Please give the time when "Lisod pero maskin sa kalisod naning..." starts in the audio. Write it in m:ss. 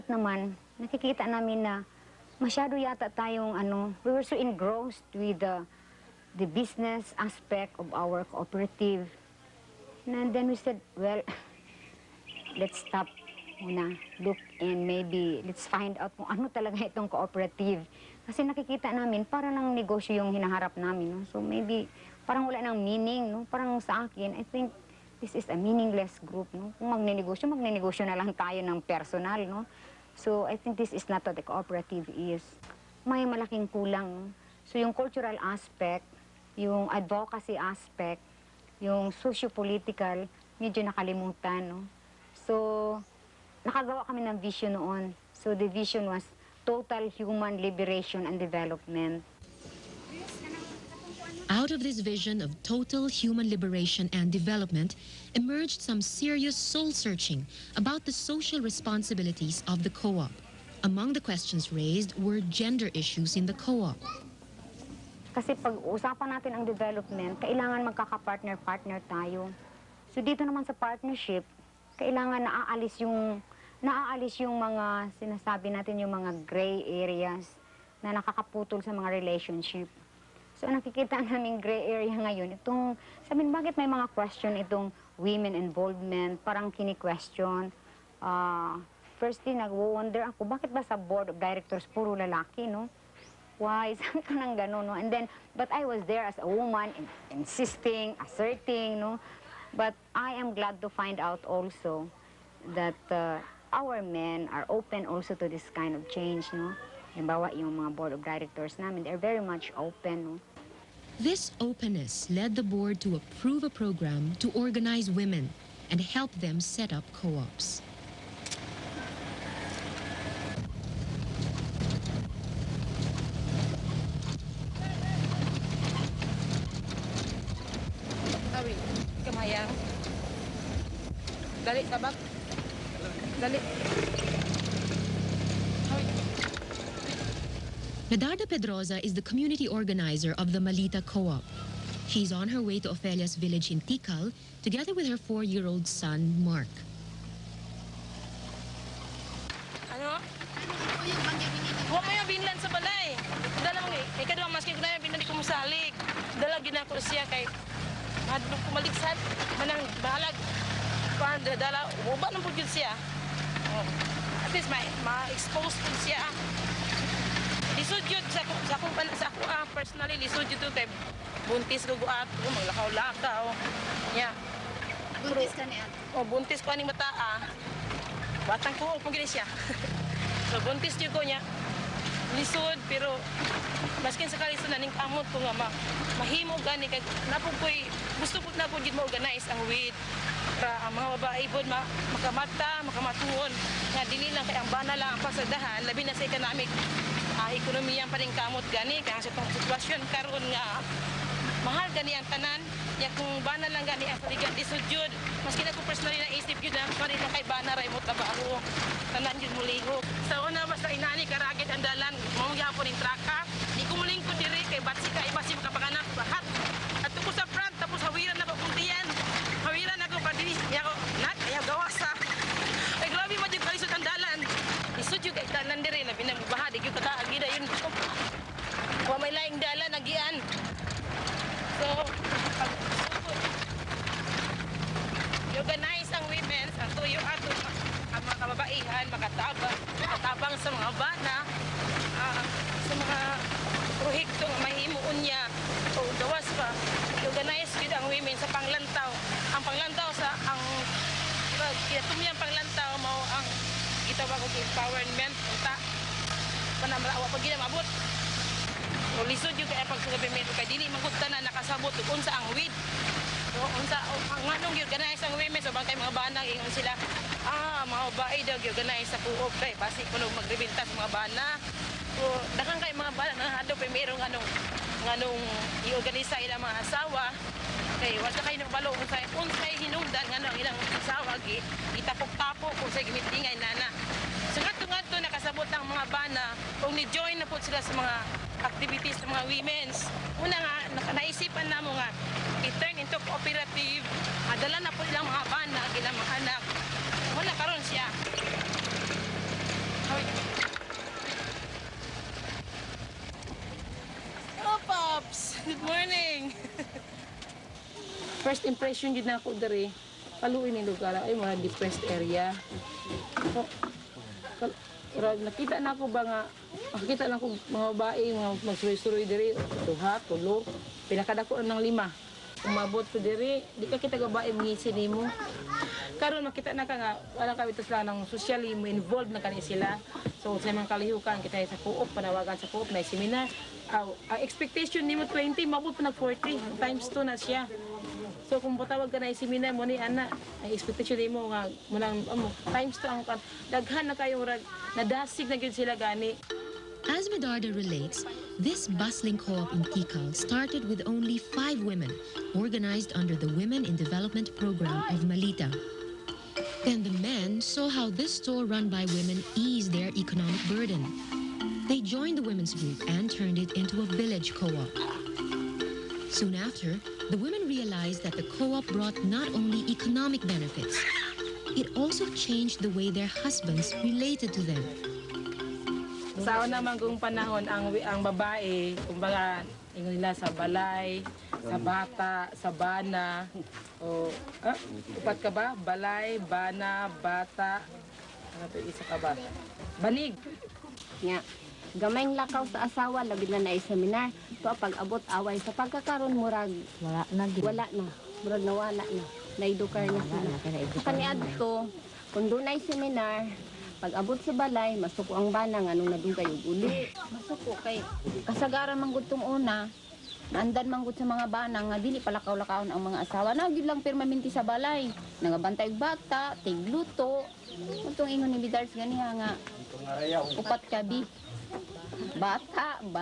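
3:02.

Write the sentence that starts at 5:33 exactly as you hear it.
Ang expectation ni mo 20, mabot pa nag 40, times 2 na siya.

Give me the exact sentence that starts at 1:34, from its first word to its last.
And then, but I was there as a woman, in insisting, asserting, no?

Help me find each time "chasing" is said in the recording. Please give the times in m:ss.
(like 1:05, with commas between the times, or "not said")
not said.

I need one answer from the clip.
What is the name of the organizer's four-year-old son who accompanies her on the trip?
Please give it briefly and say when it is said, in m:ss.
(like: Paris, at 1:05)
Mark, at 2:26.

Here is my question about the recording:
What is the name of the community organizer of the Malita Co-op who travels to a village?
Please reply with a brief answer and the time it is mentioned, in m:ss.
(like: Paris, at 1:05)
Medarda Pedroza, at 2:18.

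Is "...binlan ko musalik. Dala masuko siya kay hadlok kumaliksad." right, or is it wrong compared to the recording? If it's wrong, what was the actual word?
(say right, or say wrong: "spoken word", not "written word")
wrong: "ginako", not "masuko".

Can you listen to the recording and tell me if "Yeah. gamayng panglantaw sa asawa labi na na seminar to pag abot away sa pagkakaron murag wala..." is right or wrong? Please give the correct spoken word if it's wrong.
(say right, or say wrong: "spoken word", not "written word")
wrong: "lakaw", not "panglantaw".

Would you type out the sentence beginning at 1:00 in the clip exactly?
Among the questions raised were gender issues in the co-op.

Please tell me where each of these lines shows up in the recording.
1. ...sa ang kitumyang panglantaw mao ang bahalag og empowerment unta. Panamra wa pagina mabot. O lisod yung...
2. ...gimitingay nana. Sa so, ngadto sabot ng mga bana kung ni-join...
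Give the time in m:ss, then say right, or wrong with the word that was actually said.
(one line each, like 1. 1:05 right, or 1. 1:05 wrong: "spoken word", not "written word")
1. 4:10 wrong: "gitawag", not "bahalag"
2. 4:43 right.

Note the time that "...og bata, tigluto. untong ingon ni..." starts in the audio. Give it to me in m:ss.
6:55.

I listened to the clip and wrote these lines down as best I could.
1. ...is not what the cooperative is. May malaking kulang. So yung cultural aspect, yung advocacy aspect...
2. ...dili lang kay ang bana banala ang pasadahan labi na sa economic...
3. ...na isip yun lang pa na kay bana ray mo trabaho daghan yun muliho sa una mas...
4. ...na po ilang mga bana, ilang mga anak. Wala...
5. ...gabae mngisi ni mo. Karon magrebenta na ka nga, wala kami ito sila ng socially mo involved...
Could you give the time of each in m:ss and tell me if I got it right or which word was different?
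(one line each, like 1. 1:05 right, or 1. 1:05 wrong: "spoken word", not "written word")
1. 0:30 right
2. 3:14 right
3. 3:26 wrong: "tanan", not "daghan"
4. 4:54 right
5. 5:24 wrong: "makita", not "magrebenta".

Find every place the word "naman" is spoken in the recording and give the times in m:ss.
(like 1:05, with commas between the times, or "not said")
0:00, 1:10, 6:16.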